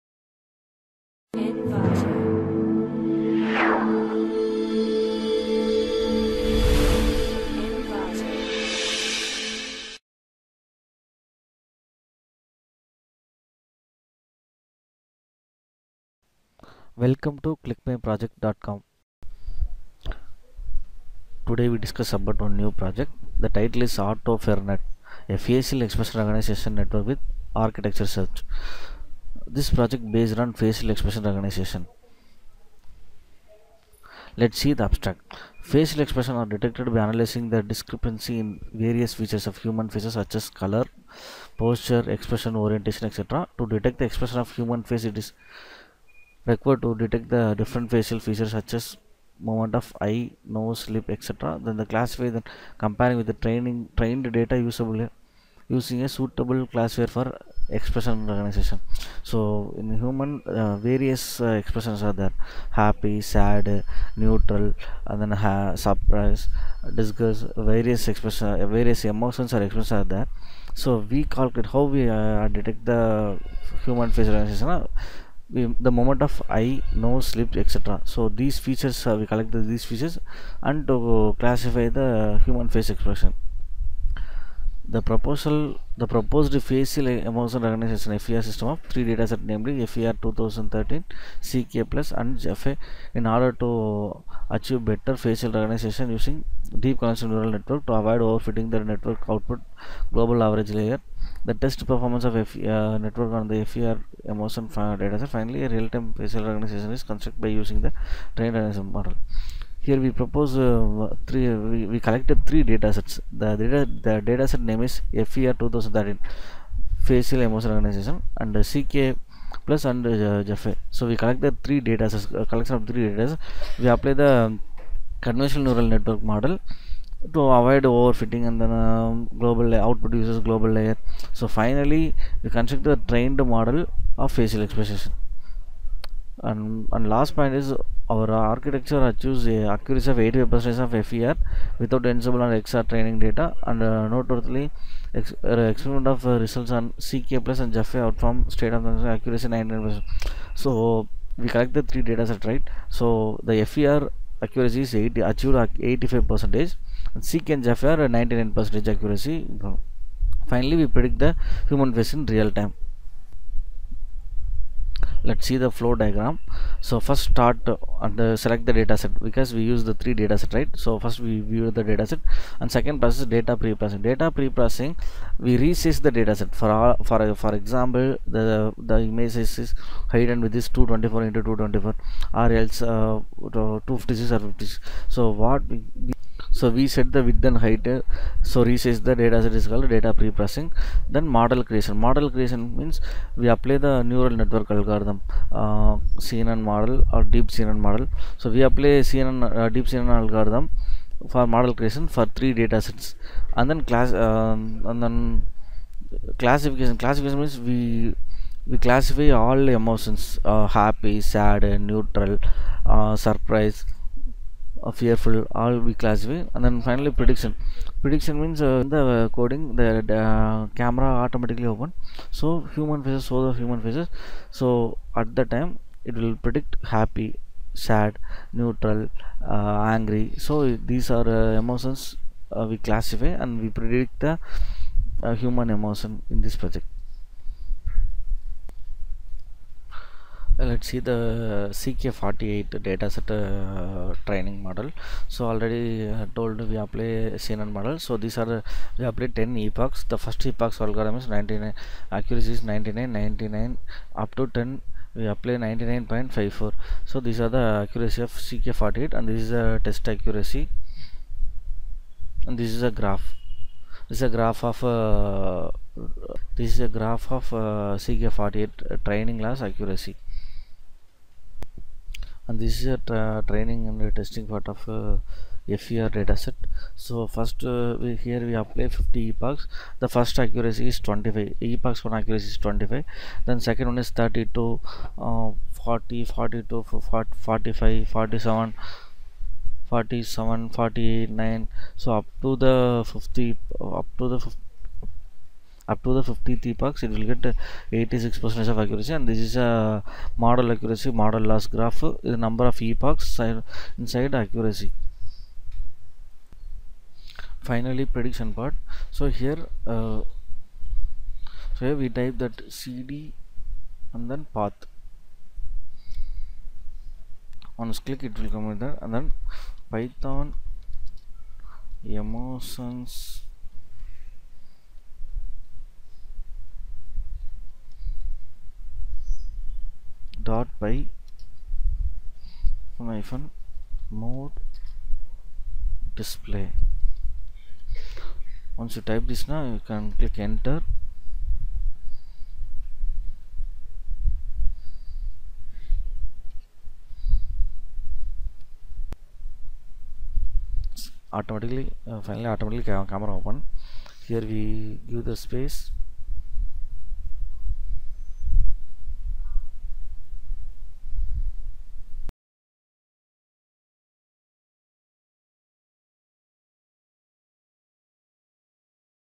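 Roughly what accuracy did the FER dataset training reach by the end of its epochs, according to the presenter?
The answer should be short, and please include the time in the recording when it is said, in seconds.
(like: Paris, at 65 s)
86 percent, at 297 s.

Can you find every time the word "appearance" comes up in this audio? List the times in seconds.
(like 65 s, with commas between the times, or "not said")
not said.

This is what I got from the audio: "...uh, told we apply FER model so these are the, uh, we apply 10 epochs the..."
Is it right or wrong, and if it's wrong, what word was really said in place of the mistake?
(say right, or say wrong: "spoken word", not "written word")
wrong: "CNN", not "FER".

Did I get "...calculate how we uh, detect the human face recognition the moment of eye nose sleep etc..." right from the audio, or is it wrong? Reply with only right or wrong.
right.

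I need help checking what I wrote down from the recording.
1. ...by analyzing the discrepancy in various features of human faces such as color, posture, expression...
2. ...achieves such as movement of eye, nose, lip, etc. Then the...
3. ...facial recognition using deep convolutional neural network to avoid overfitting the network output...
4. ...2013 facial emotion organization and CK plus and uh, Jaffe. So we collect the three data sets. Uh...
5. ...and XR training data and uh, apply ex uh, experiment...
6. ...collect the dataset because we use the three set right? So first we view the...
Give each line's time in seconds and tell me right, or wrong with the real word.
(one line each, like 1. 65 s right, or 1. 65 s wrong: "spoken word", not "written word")
1. 36 s right
2. 48 s wrong: "features", not "achieves"
3. 95 s right
4. 115 s right
5. 142 s wrong: "notably", not "apply"
6. 168 s wrong: "select", not "collect".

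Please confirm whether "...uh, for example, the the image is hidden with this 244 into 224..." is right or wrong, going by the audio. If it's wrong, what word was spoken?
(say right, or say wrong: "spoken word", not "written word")
wrong: "224", not "244".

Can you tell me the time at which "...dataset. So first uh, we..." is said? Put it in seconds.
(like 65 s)
276 s.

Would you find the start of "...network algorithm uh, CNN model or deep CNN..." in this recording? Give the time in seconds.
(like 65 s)
194 s.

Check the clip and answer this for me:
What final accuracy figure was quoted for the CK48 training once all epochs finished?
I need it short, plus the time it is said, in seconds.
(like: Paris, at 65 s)
99.54, at 255 s.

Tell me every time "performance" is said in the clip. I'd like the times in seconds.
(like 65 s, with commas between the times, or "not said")
101 s.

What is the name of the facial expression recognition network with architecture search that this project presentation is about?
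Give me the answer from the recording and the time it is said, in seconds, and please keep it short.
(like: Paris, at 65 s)
AutoFERNet, at 23 s.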